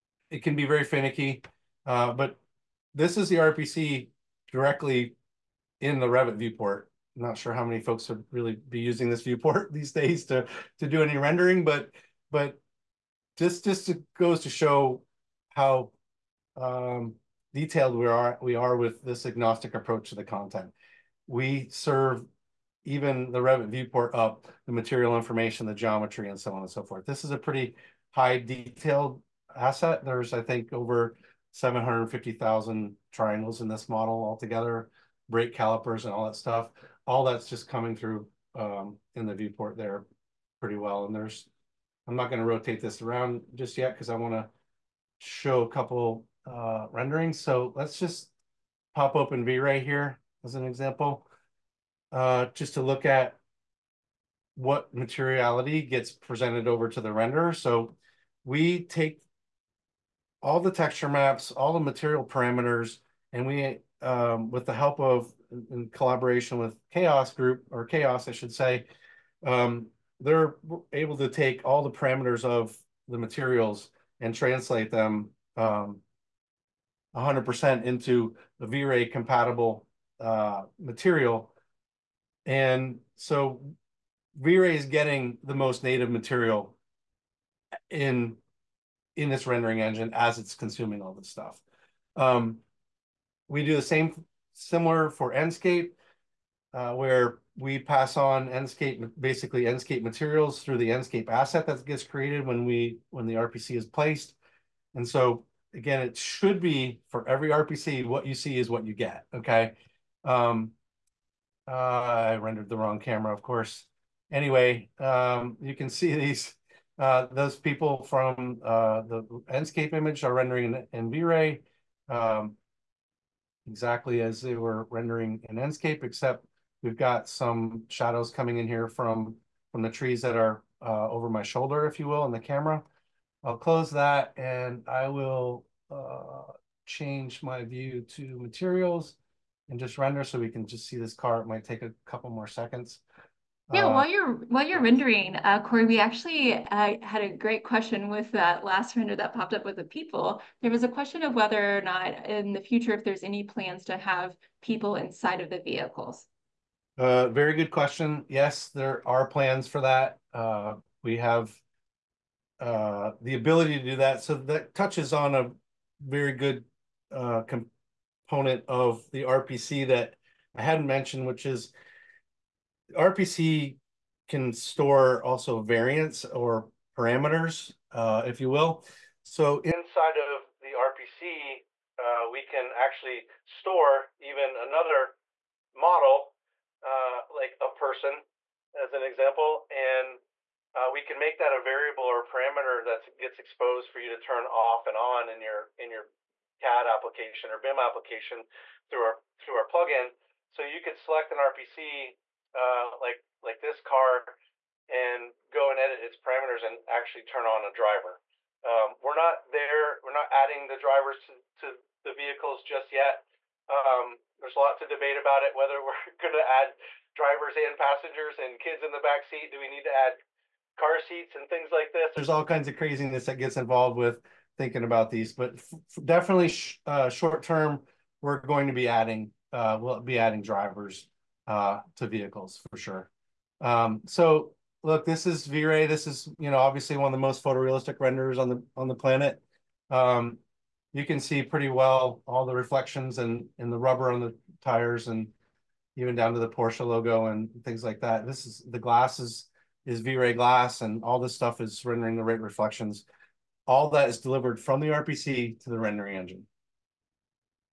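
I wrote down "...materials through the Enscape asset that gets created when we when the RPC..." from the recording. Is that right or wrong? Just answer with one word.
right.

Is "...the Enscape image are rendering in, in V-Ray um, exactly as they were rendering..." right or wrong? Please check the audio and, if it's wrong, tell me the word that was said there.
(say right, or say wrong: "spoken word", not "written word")
right.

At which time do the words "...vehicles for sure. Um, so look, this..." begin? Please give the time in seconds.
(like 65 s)
232 s.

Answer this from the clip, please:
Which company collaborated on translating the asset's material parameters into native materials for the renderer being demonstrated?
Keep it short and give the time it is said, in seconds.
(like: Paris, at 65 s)
Chaos Group, at 66 s.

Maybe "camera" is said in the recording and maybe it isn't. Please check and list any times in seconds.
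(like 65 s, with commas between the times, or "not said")
112 s, 132 s.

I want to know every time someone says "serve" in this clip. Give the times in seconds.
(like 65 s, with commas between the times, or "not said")
21 s.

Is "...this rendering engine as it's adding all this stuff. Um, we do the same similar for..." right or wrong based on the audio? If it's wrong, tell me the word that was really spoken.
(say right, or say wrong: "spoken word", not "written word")
wrong: "consuming", not "adding".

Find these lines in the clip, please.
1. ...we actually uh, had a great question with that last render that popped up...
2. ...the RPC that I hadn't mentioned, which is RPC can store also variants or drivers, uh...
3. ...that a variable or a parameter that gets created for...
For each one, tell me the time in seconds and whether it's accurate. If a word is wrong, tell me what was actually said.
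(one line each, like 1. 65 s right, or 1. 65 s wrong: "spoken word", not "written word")
1. 145 s right
2. 169 s wrong: "parameters", not "drivers"
3. 191 s wrong: "exposed", not "created".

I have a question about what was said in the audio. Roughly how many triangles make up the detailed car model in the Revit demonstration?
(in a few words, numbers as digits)
over 750,000.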